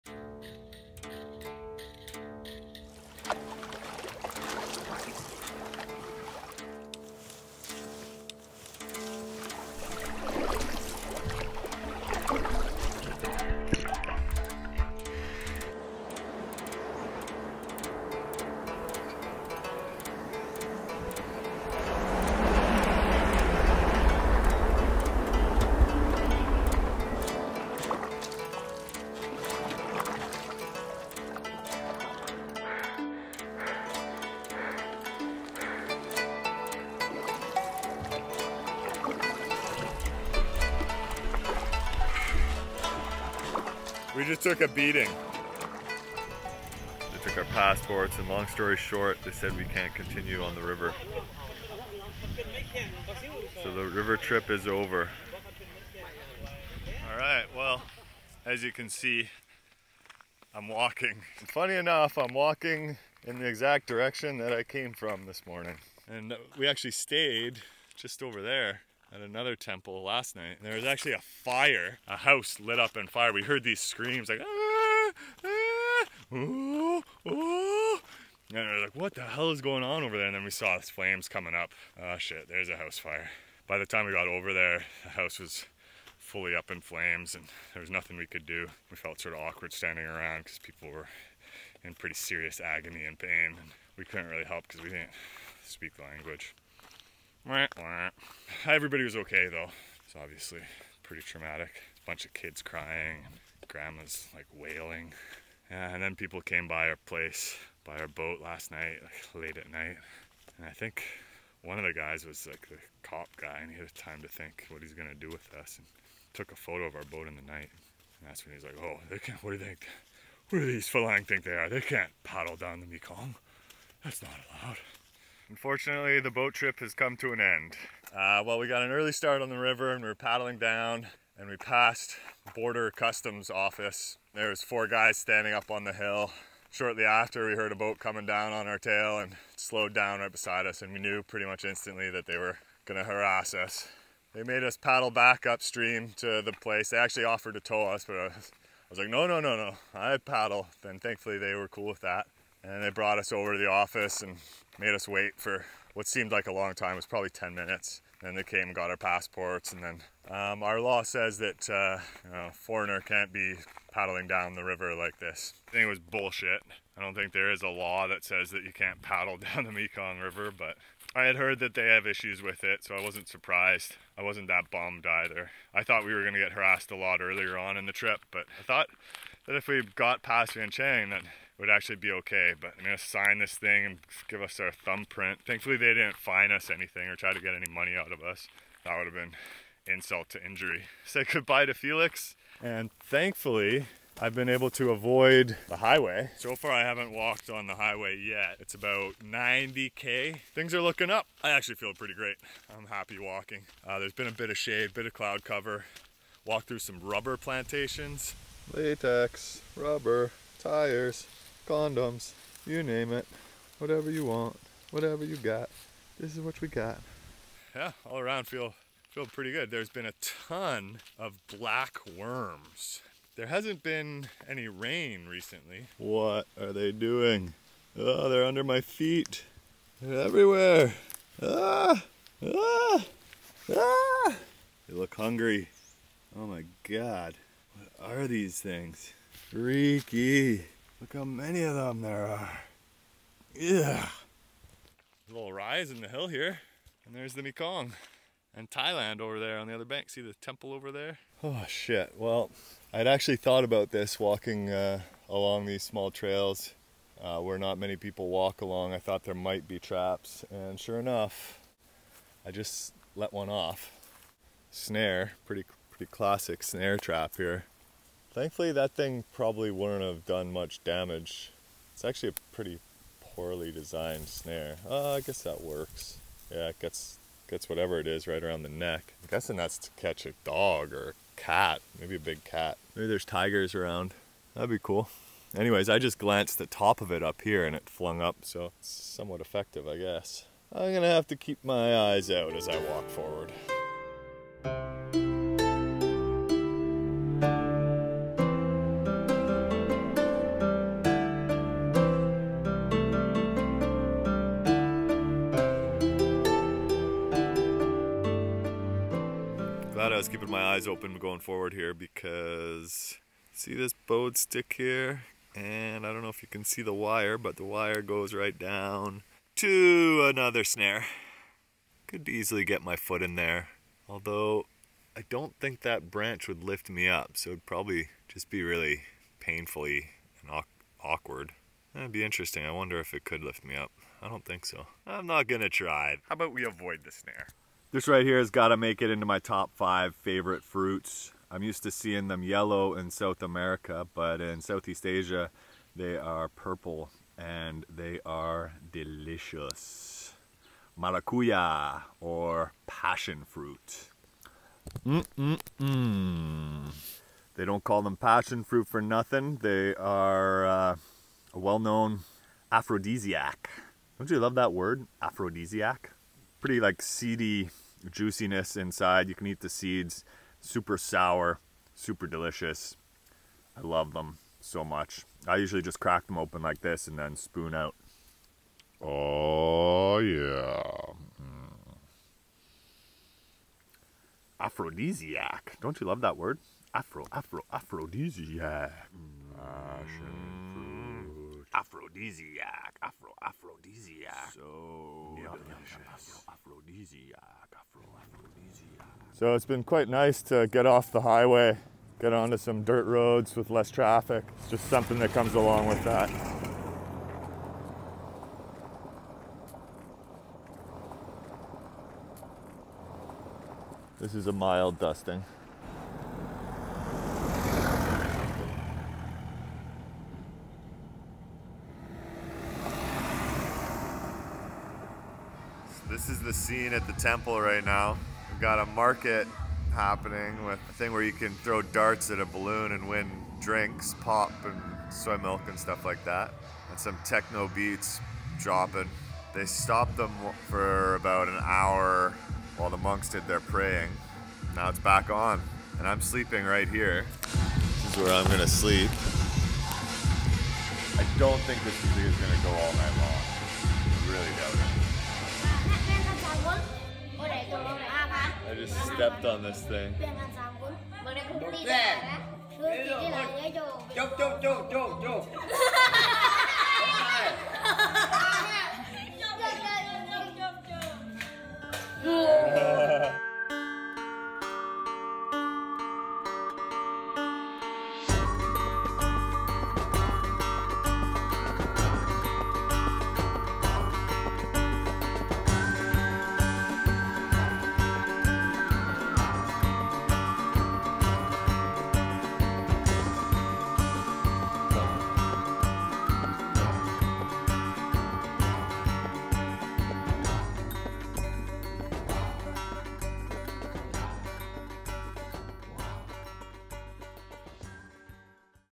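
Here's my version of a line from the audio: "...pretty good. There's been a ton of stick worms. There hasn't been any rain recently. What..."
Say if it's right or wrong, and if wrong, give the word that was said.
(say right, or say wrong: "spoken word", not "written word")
wrong: "black", not "stick".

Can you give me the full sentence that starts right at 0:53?
So the river trip is over.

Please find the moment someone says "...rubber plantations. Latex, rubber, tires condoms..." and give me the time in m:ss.
3:26.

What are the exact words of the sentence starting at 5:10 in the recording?
glad I was keeping my eyes open going forward here because see this bowed stick here?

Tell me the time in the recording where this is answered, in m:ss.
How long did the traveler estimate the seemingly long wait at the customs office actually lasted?
2:37.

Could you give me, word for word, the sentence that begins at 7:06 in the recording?
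scene at the temple right now.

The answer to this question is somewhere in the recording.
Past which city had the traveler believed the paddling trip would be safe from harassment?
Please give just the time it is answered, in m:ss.
3:00.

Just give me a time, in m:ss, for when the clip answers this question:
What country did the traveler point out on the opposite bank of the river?
4:08.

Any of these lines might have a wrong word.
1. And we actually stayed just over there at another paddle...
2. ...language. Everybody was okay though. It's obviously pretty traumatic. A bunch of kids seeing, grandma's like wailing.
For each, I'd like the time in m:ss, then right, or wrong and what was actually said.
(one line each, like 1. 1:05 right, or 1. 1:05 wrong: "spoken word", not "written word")
1. 1:06 wrong: "temple", not "paddle"
2. 1:36 wrong: "crying", not "seeing".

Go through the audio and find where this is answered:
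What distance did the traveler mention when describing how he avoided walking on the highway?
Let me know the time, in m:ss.
3:19.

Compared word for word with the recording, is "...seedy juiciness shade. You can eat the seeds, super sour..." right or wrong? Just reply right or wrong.
wrong.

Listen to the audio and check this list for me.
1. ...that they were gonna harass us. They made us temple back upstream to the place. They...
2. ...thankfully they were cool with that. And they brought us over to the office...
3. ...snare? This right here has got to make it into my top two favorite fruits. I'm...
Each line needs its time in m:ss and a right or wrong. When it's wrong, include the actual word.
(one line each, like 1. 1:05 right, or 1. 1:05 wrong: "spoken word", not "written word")
1. 2:22 wrong: "paddle", not "temple"
2. 2:31 right
3. 5:37 wrong: "five", not "two".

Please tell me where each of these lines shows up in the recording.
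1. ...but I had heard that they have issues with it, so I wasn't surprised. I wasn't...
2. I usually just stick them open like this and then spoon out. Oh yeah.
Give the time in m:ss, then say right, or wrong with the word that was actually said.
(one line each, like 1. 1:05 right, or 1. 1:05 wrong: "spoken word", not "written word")
1. 2:50 right
2. 6:15 wrong: "crack", not "stick".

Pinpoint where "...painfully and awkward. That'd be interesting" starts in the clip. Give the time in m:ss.
5:29.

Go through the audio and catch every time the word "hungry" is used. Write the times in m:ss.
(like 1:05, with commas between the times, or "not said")
3:55.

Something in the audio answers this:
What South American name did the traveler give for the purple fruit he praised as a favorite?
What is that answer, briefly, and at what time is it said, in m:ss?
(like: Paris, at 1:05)
Maracuya, at 5:50.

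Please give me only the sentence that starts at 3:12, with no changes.
And thankfully, I've been able to avoid the highway.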